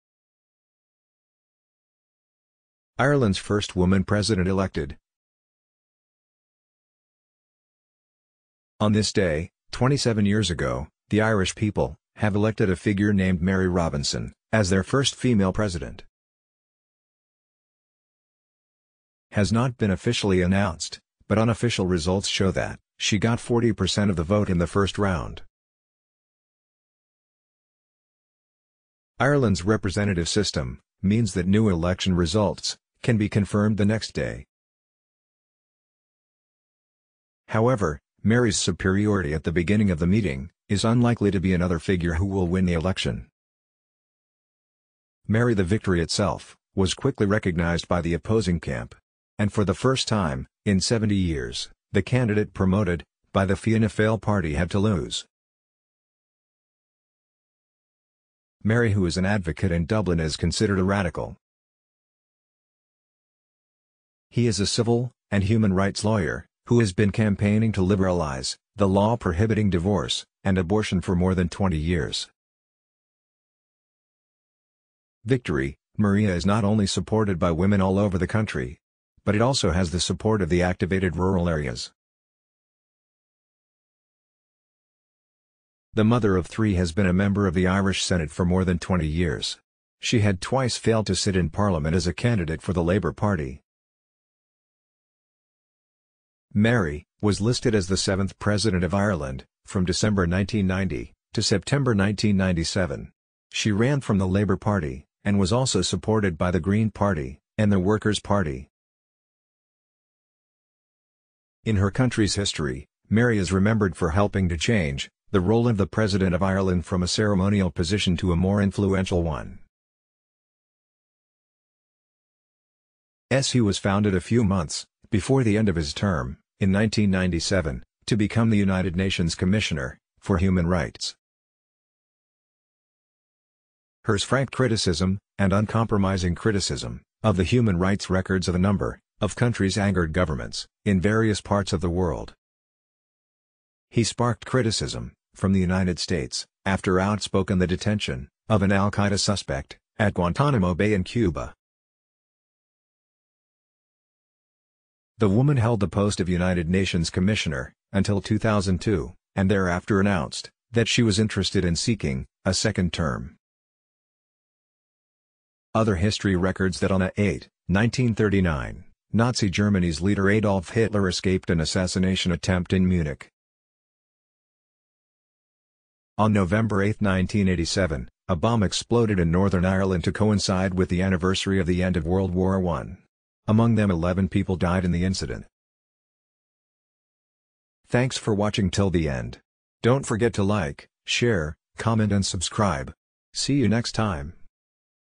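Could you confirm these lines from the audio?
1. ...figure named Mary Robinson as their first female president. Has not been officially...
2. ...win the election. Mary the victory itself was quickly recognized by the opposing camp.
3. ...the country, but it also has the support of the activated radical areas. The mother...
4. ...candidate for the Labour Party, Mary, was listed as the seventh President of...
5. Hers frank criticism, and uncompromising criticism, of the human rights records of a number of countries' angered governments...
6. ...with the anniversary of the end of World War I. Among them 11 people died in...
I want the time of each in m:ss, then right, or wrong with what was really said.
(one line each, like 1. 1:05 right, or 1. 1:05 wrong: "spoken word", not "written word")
1. 0:12 right
2. 0:42 right
3. 1:18 wrong: "rural", not "radical"
4. 1:32 right
5. 2:14 right
6. 3:00 right.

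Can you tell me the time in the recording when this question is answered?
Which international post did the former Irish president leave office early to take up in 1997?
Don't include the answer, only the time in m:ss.
2:08.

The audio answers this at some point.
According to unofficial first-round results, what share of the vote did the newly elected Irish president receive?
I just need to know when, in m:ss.
0:23.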